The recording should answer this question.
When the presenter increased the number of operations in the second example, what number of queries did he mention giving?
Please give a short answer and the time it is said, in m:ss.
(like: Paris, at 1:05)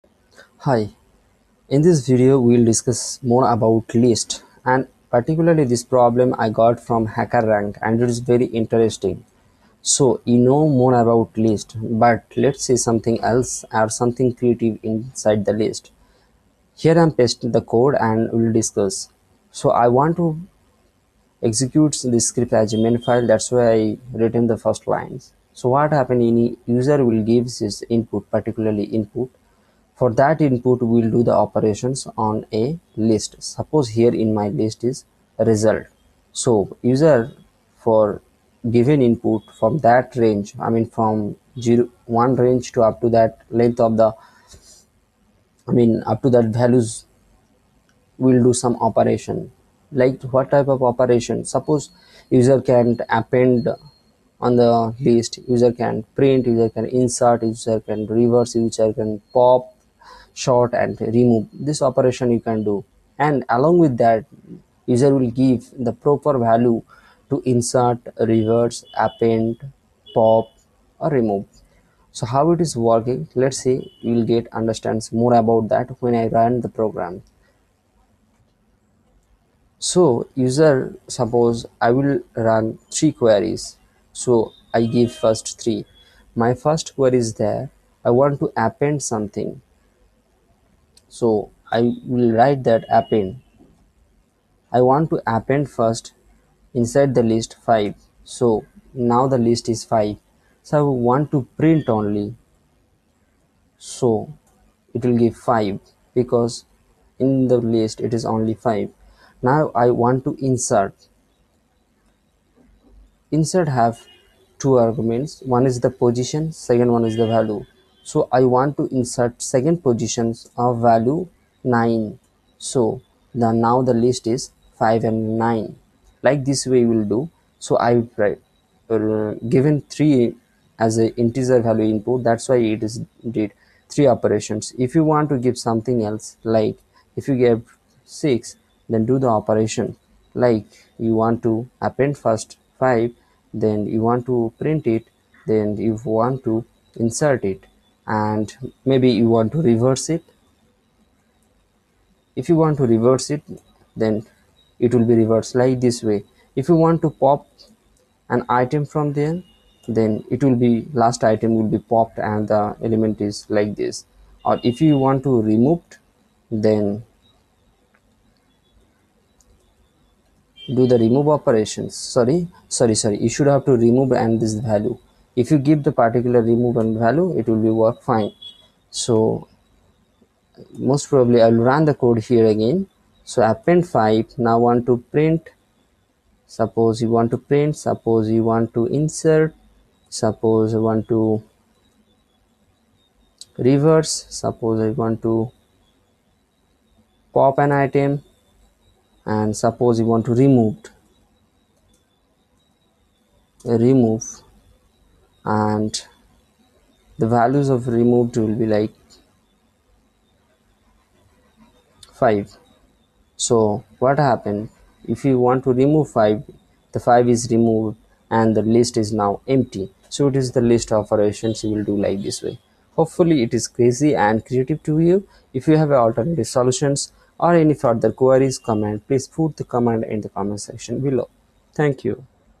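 6, at 2:18.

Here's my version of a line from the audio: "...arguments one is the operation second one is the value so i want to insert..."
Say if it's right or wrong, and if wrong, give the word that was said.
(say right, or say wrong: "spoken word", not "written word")
wrong: "position", not "operation".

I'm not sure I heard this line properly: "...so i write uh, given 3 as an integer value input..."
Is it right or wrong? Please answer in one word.
right.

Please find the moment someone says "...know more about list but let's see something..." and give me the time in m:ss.
0:10.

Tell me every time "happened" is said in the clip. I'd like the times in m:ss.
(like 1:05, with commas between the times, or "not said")
0:25, 3:34.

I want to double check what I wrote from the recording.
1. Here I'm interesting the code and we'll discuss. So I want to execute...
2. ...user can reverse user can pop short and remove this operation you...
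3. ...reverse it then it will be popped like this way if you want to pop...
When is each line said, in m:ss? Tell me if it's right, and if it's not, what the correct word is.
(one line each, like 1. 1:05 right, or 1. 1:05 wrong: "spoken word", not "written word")
1. 0:16 wrong: "pasting", not "interesting"
2. 0:57 right
3. 2:32 wrong: "reversed", not "popped".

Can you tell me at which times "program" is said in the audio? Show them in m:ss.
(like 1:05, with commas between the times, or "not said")
1:16.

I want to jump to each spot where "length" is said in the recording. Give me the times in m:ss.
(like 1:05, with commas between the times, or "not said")
0:43.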